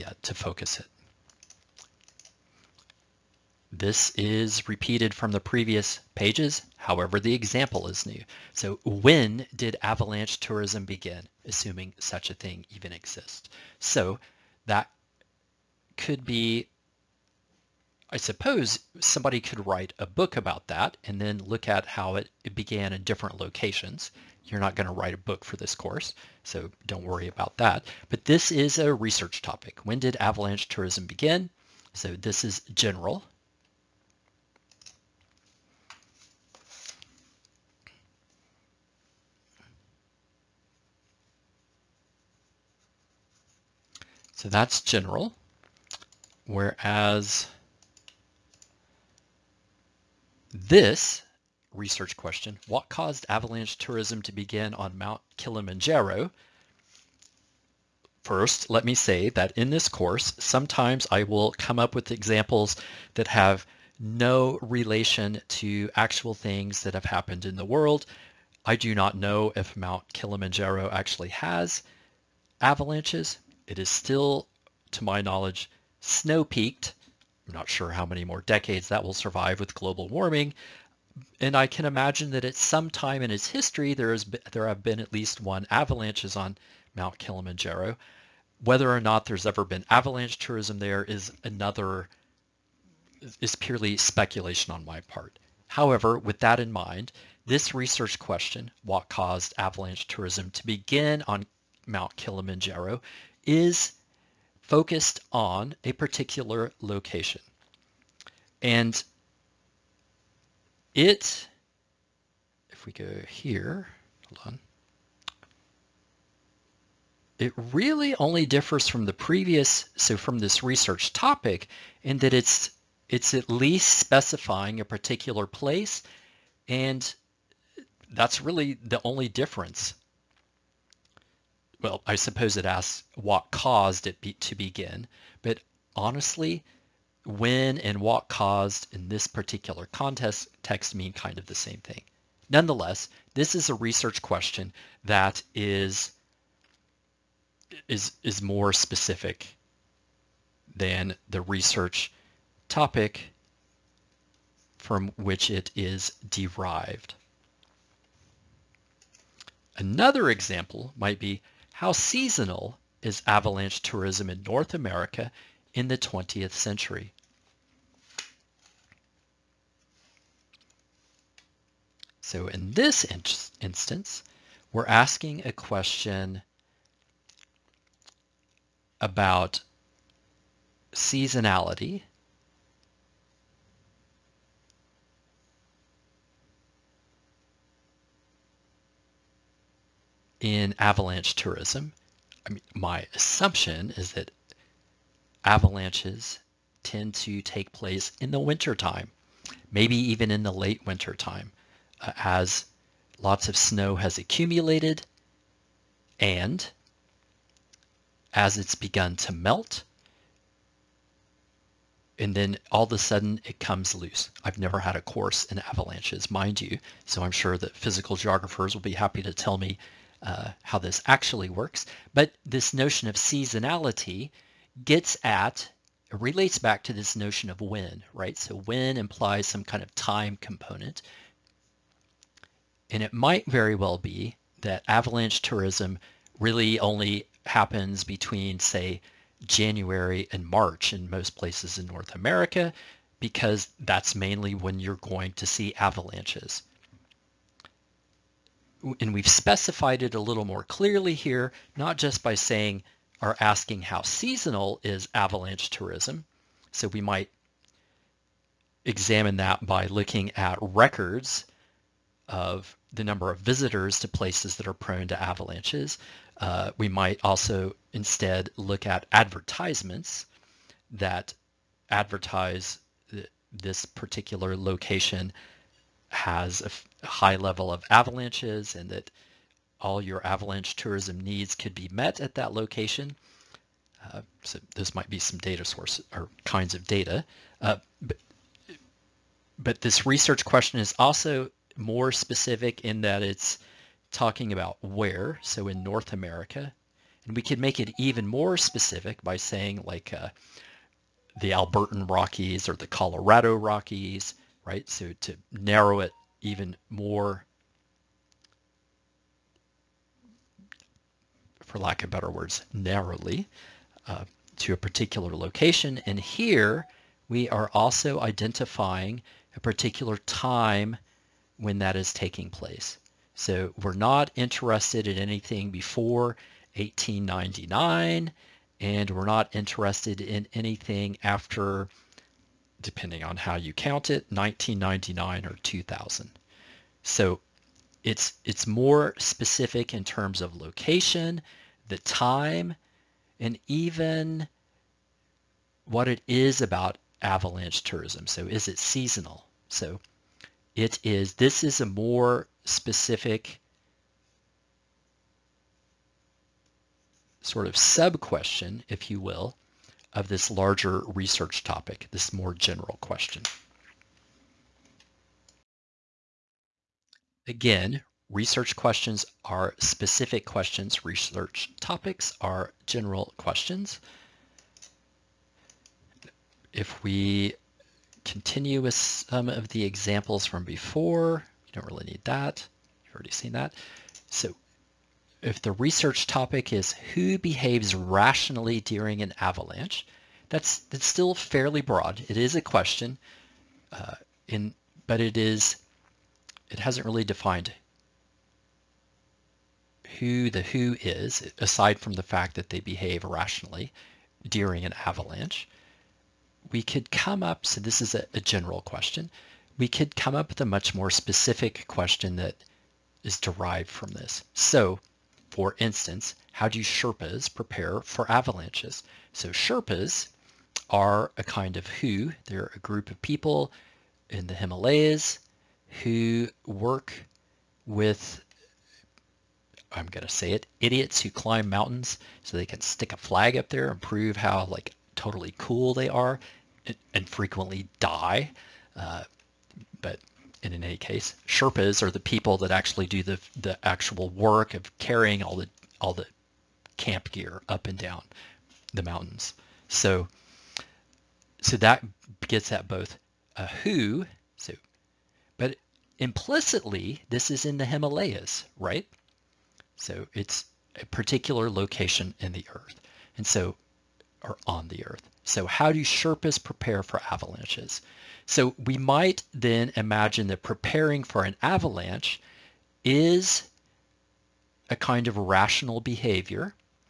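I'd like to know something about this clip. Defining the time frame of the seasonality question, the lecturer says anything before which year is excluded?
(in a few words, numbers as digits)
1899.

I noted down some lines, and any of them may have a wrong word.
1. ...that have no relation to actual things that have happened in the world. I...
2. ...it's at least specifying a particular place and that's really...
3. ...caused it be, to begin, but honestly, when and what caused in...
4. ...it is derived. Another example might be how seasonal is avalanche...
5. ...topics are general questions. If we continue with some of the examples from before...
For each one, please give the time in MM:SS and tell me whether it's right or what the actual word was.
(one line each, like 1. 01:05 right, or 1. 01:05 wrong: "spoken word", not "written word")
1. 01:03 right
2. 02:03 right
3. 02:13 right
4. 02:35 right
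5. 06:11 right.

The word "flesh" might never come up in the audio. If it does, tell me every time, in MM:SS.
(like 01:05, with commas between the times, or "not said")
not said.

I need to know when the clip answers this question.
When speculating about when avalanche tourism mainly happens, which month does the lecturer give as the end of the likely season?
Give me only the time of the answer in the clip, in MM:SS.
04:00.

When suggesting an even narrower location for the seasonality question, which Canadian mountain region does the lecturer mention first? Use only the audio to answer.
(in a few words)
Albertan Rockies.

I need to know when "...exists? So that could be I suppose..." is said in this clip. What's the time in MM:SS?
00:12.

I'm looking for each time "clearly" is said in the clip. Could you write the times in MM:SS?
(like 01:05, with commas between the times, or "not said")
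04:10.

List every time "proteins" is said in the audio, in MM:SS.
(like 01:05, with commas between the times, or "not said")
not said.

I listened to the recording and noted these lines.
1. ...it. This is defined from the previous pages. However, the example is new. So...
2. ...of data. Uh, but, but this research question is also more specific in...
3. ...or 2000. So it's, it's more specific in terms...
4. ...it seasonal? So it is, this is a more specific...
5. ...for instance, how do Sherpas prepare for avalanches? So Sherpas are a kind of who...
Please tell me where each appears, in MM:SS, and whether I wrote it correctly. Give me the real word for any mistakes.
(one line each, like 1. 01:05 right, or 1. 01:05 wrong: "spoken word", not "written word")
1. 00:00 wrong: "repeated", not "defined"
2. 04:46 right
3. 05:35 right
4. 05:48 right
5. 06:55 right.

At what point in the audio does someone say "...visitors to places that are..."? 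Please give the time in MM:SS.
04:23.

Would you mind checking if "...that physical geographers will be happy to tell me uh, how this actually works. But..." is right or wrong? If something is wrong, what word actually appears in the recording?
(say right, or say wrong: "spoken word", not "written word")
right.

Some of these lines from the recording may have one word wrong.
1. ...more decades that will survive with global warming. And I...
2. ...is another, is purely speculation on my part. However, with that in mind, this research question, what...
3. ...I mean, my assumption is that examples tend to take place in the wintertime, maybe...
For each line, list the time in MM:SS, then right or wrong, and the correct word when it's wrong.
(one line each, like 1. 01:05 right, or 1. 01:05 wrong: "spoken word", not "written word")
1. 01:18 right
2. 01:31 right
3. 03:12 wrong: "avalanches", not "examples".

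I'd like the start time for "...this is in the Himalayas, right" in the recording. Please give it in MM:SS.
07:37.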